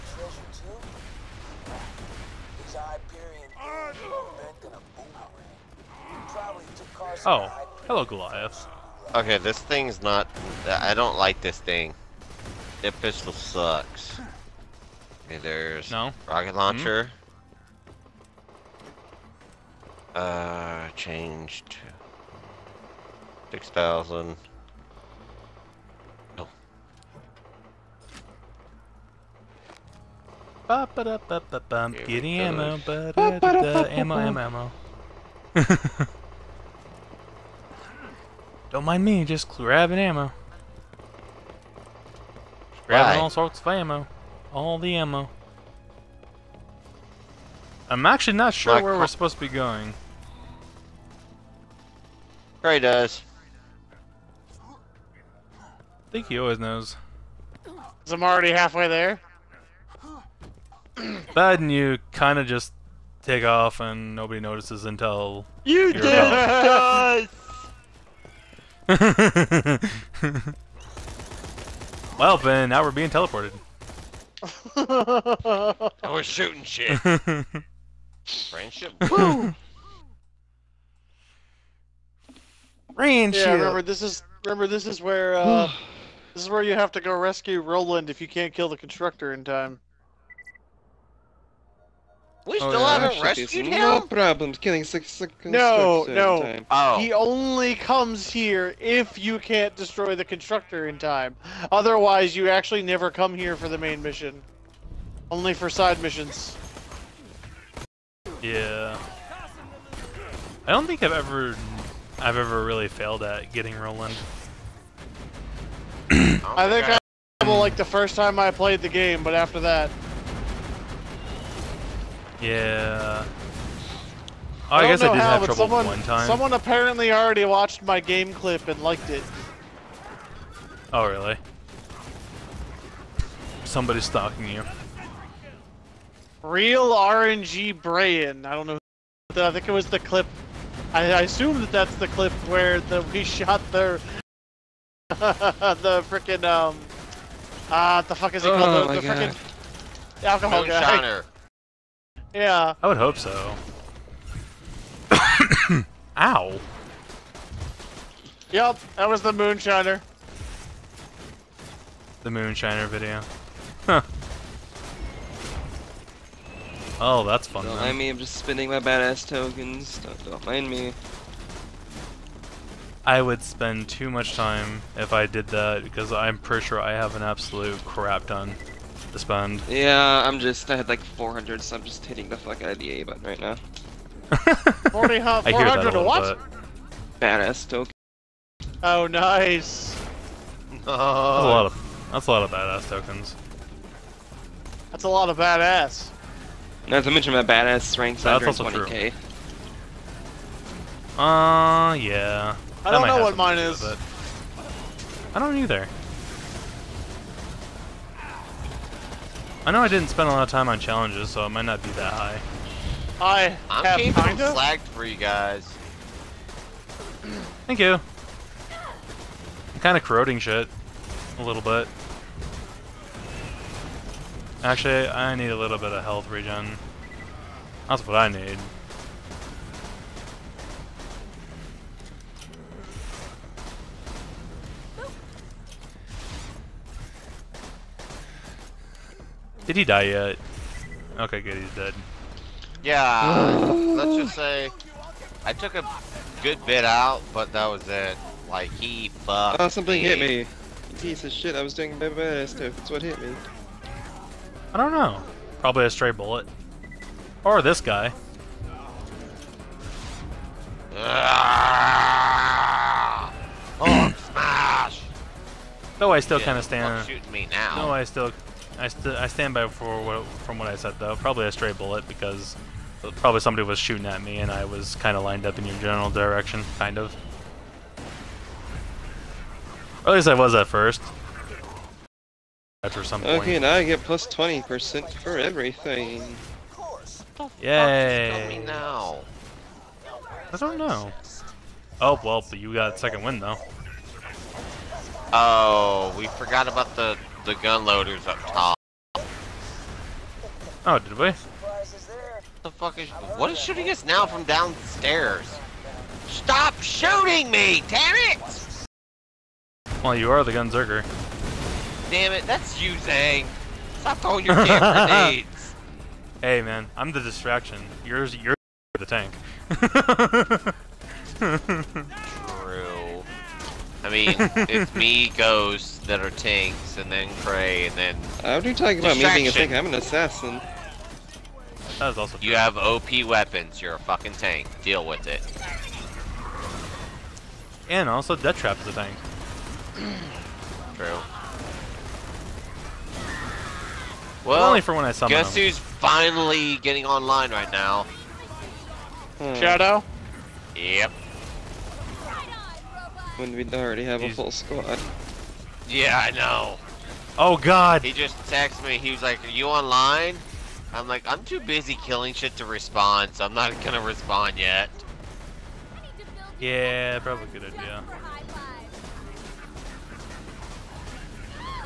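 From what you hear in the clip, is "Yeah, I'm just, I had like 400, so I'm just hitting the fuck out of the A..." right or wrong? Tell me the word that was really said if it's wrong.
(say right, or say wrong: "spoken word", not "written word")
right.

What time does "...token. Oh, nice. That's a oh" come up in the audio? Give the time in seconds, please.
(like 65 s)
187 s.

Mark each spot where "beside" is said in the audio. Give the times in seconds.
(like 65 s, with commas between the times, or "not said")
not said.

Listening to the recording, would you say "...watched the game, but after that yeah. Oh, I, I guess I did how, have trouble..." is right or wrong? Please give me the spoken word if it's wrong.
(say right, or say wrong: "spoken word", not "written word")
wrong: "played", not "watched".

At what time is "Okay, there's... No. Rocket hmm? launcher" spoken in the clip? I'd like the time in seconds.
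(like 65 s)
15 s.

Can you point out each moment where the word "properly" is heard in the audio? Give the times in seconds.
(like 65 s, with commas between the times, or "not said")
not said.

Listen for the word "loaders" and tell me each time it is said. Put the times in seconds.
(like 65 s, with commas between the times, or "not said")
297 s.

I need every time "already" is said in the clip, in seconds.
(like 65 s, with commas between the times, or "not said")
58 s, 127 s, 353 s.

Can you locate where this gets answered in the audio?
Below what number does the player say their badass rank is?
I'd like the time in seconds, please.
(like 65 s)
198 s.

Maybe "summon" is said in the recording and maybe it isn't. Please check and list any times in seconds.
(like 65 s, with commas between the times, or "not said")
345 s.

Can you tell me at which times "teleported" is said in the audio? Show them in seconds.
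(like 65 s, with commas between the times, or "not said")
73 s.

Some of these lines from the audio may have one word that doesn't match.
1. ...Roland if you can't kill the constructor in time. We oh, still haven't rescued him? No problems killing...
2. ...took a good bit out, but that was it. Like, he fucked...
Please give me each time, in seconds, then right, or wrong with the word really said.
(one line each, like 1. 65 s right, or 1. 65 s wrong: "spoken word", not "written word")
1. 87 s right
2. 245 s right.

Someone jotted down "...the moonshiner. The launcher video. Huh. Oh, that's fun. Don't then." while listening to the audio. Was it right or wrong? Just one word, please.
wrong.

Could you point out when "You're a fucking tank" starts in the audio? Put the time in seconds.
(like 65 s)
333 s.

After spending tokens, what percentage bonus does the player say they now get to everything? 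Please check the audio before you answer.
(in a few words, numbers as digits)
20%.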